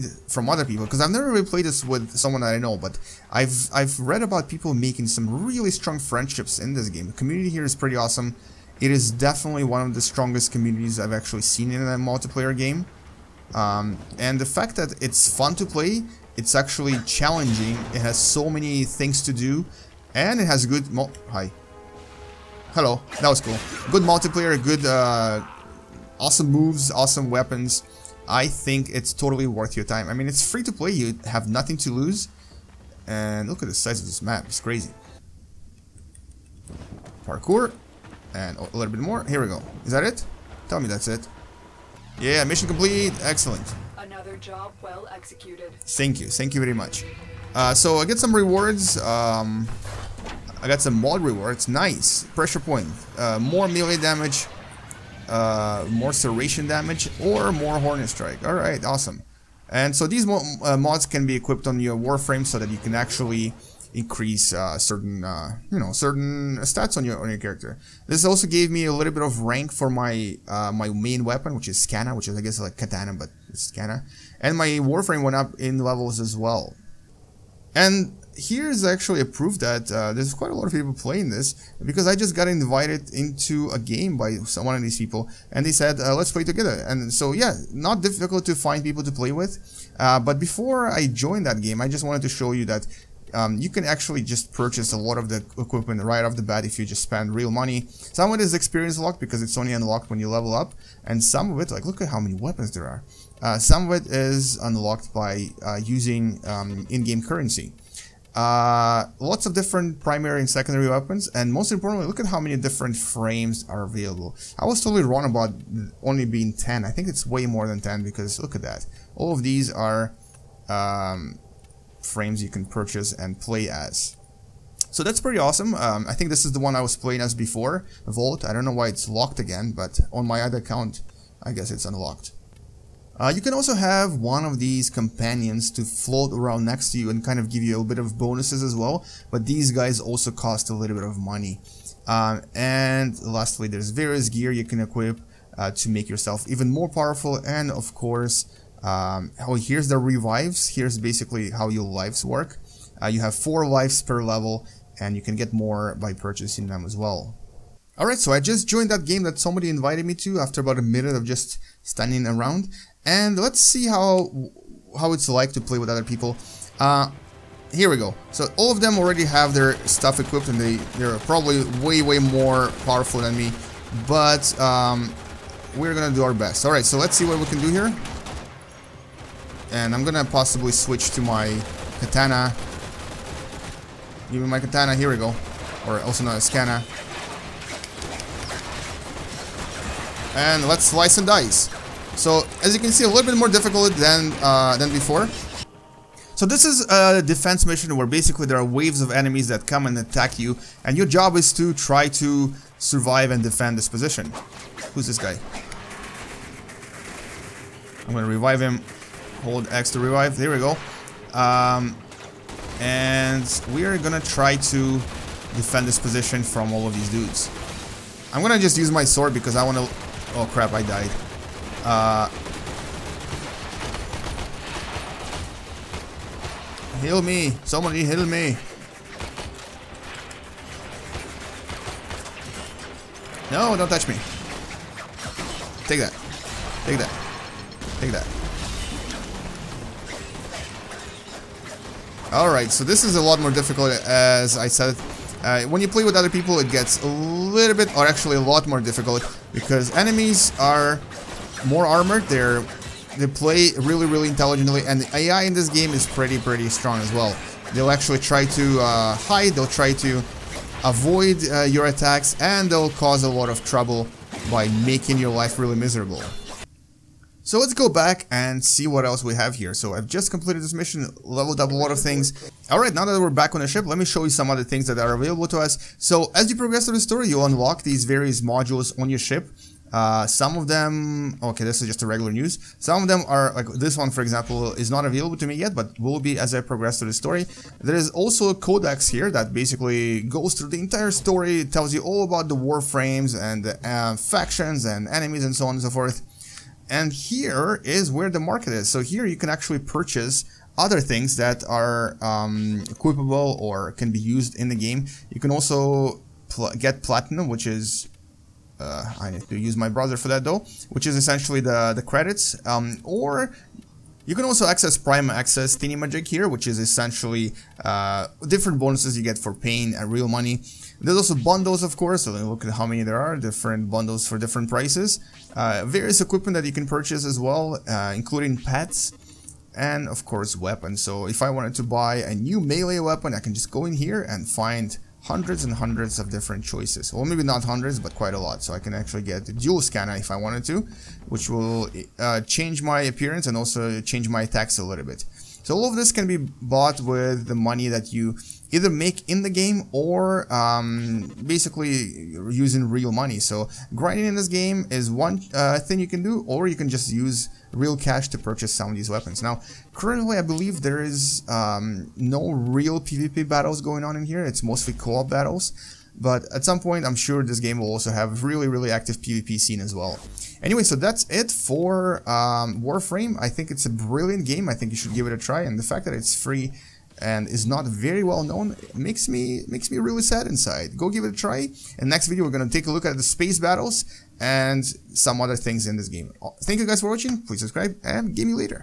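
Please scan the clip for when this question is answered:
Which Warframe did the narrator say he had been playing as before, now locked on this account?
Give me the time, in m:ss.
2:08.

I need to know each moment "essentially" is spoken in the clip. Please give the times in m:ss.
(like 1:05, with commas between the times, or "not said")
5:11, 5:16.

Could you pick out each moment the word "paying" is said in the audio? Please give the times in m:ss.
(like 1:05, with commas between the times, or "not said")
5:19.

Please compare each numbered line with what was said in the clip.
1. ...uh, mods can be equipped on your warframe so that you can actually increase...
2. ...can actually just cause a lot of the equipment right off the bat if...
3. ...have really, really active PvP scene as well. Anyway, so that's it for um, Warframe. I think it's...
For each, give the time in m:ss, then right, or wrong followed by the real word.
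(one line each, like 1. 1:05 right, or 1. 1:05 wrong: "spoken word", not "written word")
1. 1:00 right
2. 1:33 wrong: "purchase", not "cause"
3. 6:08 right.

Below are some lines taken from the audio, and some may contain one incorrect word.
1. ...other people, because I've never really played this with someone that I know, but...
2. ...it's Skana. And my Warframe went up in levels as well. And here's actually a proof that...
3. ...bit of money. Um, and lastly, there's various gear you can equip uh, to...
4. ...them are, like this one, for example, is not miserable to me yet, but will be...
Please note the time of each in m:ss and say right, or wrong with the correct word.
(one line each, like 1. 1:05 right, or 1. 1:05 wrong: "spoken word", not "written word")
1. 0:00 right
2. 1:13 right
3. 2:20 right
4. 4:43 wrong: "available", not "miserable".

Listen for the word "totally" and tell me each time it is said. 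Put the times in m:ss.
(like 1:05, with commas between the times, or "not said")
0:29, 1:54.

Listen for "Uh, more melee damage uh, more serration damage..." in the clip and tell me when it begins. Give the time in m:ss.
0:53.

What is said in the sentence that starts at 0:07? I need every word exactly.
The community here is pretty awesome.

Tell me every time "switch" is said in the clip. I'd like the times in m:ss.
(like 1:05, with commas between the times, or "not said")
3:00.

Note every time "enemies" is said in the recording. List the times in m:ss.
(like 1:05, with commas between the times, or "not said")
3:19, 4:09, 4:55.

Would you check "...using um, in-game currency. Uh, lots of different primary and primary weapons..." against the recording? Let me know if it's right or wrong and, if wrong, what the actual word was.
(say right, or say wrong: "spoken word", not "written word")
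wrong: "secondary", not "primary".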